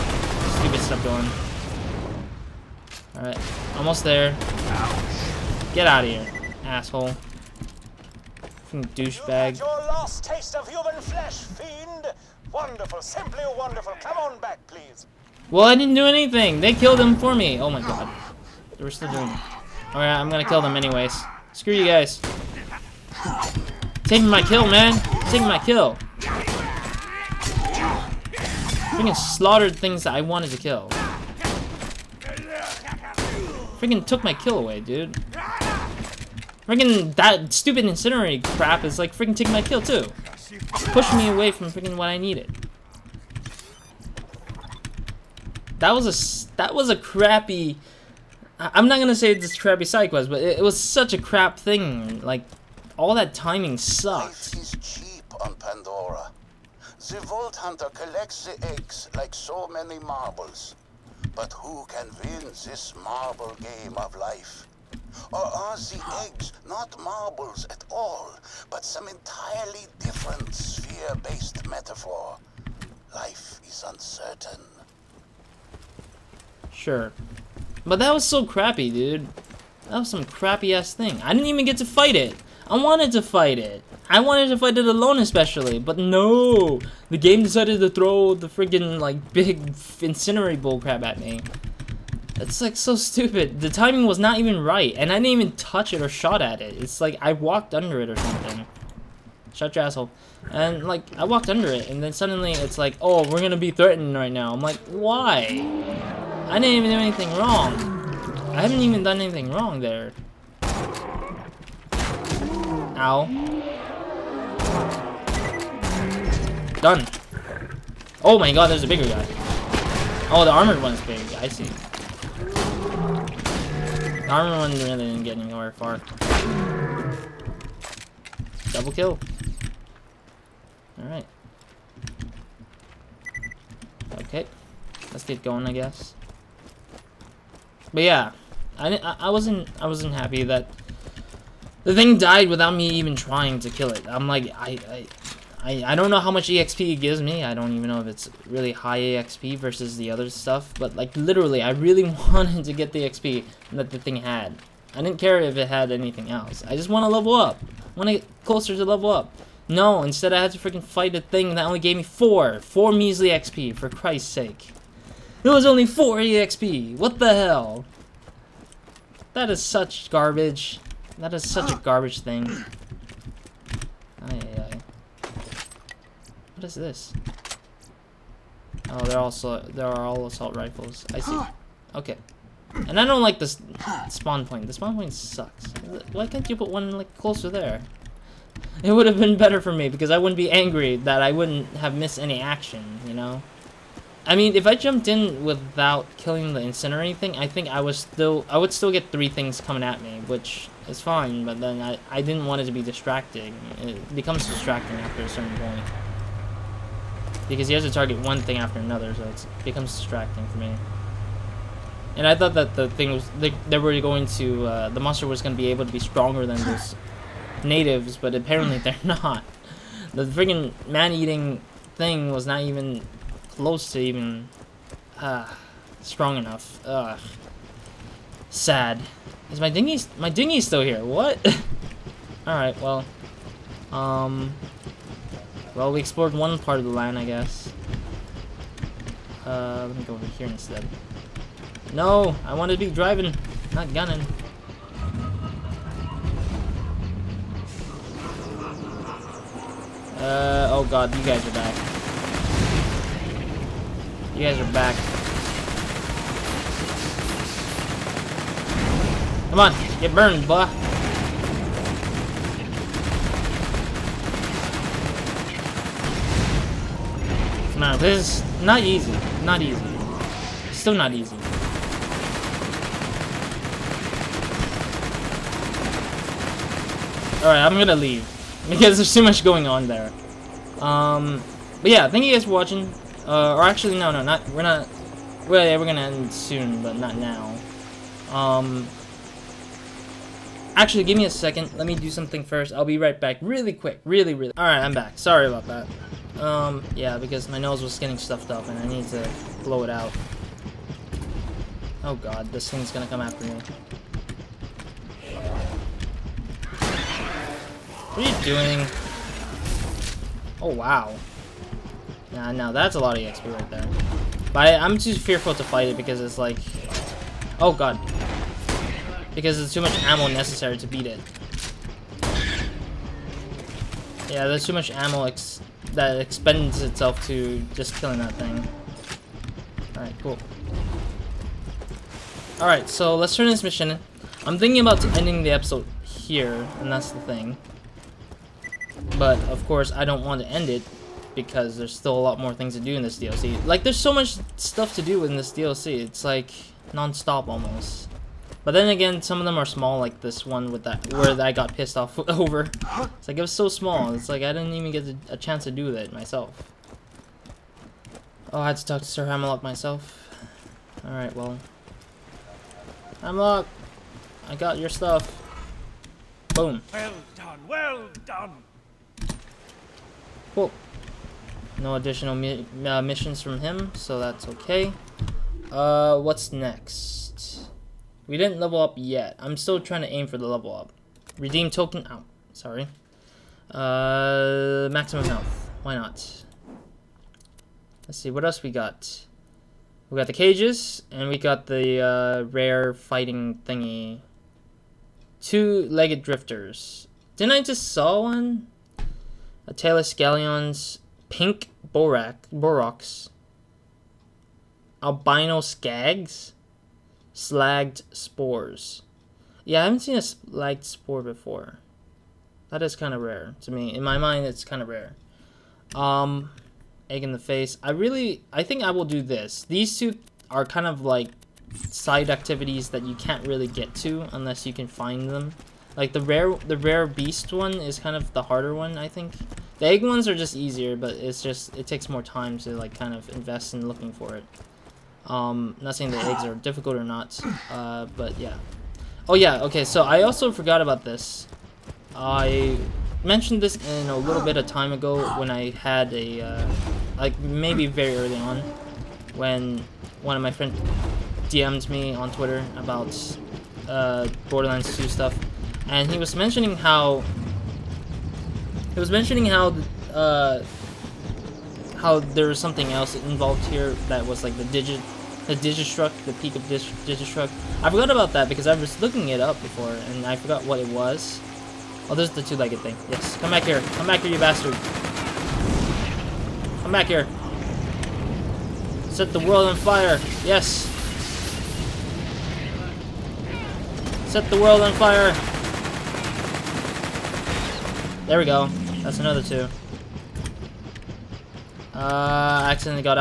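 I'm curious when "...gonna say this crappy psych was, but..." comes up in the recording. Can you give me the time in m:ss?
0:48.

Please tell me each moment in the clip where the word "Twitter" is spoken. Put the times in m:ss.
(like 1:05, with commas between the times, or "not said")
7:32.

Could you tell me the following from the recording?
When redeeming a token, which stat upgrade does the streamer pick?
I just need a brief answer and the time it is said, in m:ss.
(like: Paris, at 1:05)
Maximum health, at 6:24.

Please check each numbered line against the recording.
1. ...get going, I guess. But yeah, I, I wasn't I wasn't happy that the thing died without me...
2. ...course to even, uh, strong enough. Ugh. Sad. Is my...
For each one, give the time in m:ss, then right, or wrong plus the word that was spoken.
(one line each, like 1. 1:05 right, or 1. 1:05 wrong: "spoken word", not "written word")
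1. 2:15 right
2. 3:43 wrong: "close", not "course".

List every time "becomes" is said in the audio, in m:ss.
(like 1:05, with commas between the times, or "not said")
3:24, 3:29.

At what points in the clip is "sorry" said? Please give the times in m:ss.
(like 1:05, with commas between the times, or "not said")
4:55, 6:22.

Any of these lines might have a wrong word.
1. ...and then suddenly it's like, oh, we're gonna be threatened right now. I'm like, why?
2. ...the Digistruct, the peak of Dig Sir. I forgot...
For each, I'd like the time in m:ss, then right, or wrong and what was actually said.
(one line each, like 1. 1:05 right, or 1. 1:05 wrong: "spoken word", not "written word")
1. 1:41 right
2. 7:45 wrong: "Digistruct", not "Sir".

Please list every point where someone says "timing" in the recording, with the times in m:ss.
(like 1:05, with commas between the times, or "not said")
0:53, 1:33.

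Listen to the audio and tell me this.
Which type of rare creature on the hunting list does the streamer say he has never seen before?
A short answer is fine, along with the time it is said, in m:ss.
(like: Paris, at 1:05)
Slagged spore, at 6:50.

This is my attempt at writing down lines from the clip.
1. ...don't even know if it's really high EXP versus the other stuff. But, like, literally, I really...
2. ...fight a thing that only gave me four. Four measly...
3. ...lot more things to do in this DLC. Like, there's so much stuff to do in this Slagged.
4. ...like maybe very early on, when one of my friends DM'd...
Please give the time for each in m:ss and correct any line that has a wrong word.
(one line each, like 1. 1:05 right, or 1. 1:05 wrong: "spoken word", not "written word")
1. 2:27 right
2. 2:40 right
3. 5:42 wrong: "DLC", not "Slagged"
4. 7:27 right.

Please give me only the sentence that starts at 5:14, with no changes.
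But I, am too fearful to fight it because it's like...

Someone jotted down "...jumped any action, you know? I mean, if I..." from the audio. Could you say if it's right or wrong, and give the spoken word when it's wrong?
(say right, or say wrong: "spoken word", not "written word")
wrong: "missed", not "jumped".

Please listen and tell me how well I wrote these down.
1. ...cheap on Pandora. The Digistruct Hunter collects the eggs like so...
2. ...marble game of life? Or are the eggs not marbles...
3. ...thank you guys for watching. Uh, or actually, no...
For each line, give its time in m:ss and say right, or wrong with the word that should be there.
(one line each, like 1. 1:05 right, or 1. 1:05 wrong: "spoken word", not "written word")
1. 0:54 wrong: "Vault", not "Digistruct"
2. 1:03 right
3. 4:42 right.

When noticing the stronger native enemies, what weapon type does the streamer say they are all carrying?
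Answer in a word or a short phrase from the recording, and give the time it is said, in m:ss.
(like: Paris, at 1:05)
Assault rifles, at 3:00.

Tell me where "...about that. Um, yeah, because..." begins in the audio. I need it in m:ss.
4:55.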